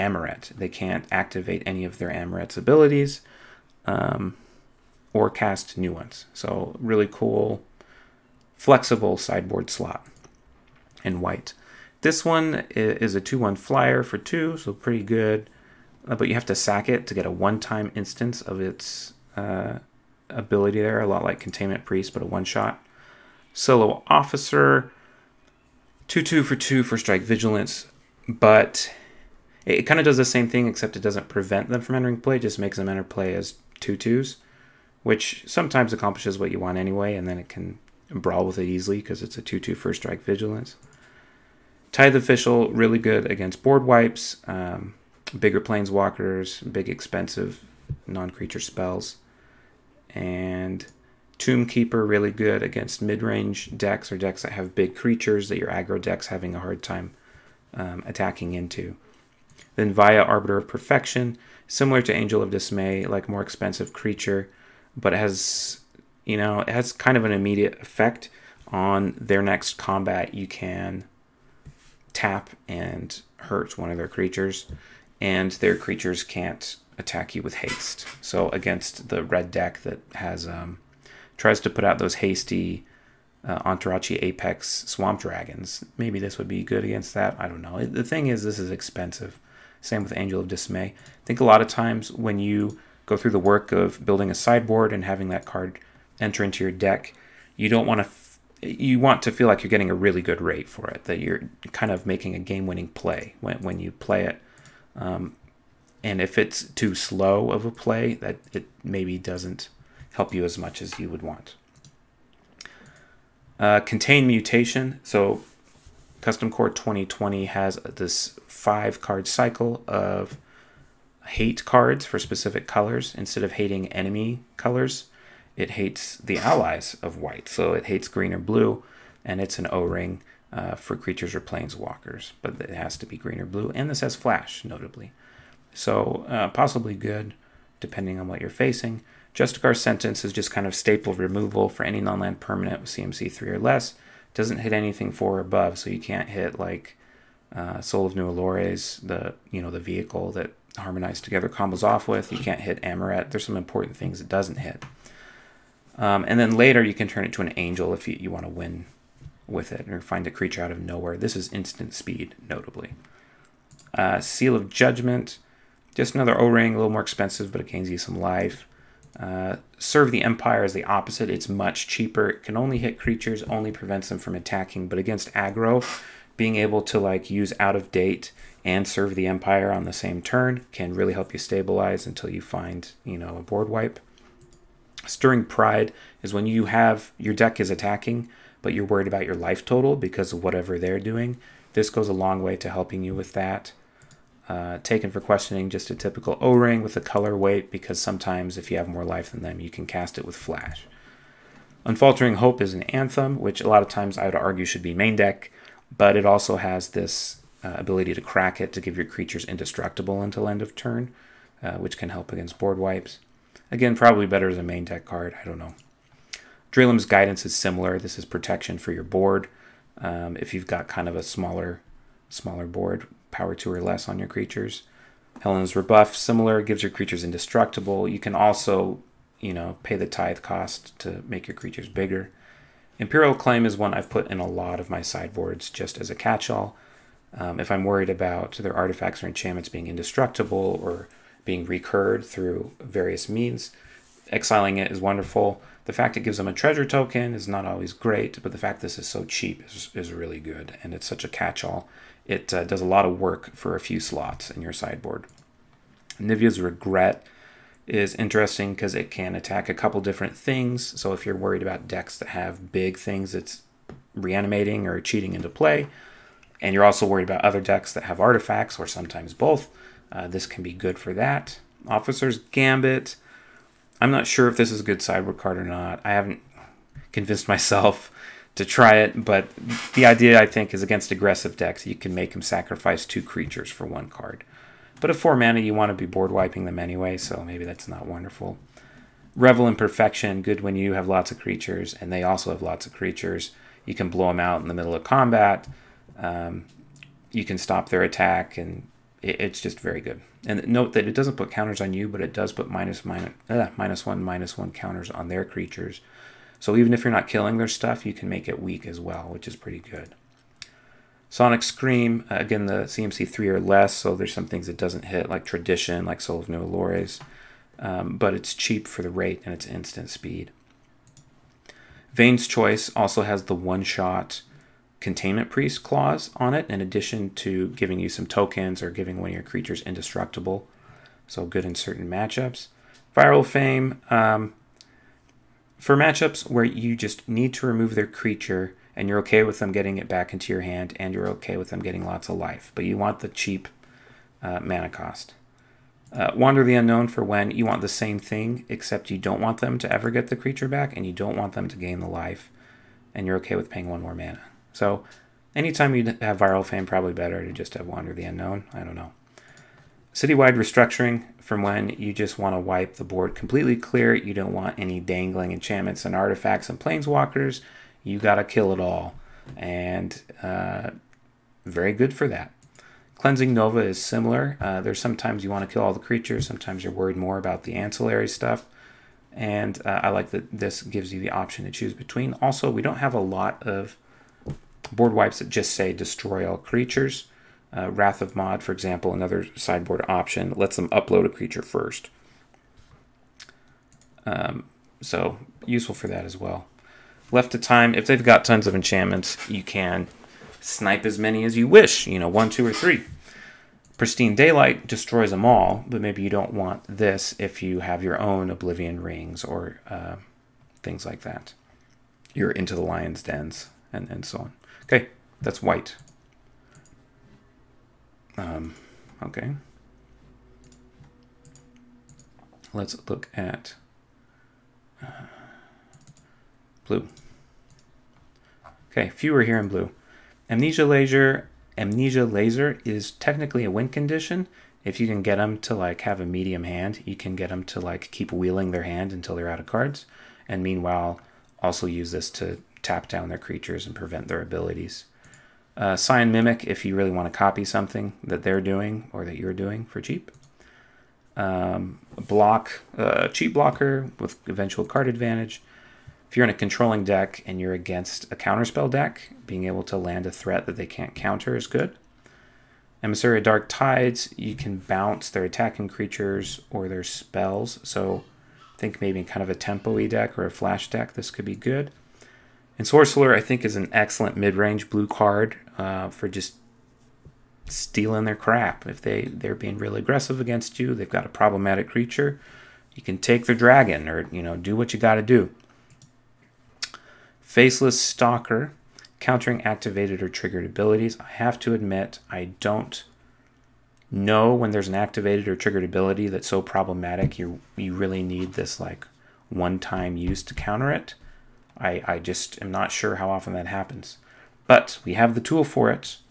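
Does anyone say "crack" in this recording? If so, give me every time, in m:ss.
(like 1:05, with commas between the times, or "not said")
3:28.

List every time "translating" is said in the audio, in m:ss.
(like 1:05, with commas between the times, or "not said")
not said.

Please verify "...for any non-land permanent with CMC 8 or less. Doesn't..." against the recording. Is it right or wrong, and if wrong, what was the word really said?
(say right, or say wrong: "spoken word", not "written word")
wrong: "3", not "8".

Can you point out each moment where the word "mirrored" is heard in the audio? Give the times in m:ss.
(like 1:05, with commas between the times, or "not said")
not said.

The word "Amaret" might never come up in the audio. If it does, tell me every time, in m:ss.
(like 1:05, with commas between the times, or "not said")
0:02, 2:32.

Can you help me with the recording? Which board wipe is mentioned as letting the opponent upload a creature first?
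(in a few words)
Wrath of Mod.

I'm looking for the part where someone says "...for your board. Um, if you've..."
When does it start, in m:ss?
3:38.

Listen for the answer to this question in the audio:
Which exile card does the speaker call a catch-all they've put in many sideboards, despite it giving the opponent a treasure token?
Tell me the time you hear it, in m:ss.
3:52.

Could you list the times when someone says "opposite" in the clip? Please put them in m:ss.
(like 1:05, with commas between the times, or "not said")
2:50.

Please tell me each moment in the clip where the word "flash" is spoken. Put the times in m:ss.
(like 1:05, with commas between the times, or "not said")
2:14, 3:20, 7:50.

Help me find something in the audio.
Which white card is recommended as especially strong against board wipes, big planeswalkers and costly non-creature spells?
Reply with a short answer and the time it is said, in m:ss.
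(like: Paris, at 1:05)
Tithe Official, at 0:41.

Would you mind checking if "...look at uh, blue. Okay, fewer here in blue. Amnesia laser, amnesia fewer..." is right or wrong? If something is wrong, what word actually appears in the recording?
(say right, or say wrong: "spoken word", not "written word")
wrong: "laser", not "fewer".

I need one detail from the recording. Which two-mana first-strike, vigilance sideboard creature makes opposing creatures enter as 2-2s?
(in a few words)
Solo Officer.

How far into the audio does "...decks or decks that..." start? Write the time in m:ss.
0:53.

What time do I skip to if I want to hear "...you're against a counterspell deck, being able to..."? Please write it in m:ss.
7:37.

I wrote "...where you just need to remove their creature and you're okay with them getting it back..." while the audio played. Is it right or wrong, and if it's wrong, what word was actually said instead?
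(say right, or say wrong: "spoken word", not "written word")
right.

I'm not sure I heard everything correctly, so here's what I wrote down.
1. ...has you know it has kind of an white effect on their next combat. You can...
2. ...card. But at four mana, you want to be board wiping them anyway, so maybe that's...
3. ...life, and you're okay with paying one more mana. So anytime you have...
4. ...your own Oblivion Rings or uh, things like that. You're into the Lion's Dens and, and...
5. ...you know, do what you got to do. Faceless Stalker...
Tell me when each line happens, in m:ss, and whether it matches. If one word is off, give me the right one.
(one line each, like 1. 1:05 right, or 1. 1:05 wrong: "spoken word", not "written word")
1. 1:05 wrong: "immediate", not "white"
2. 4:44 right
3. 5:52 right
4. 6:48 right
5. 8:04 right.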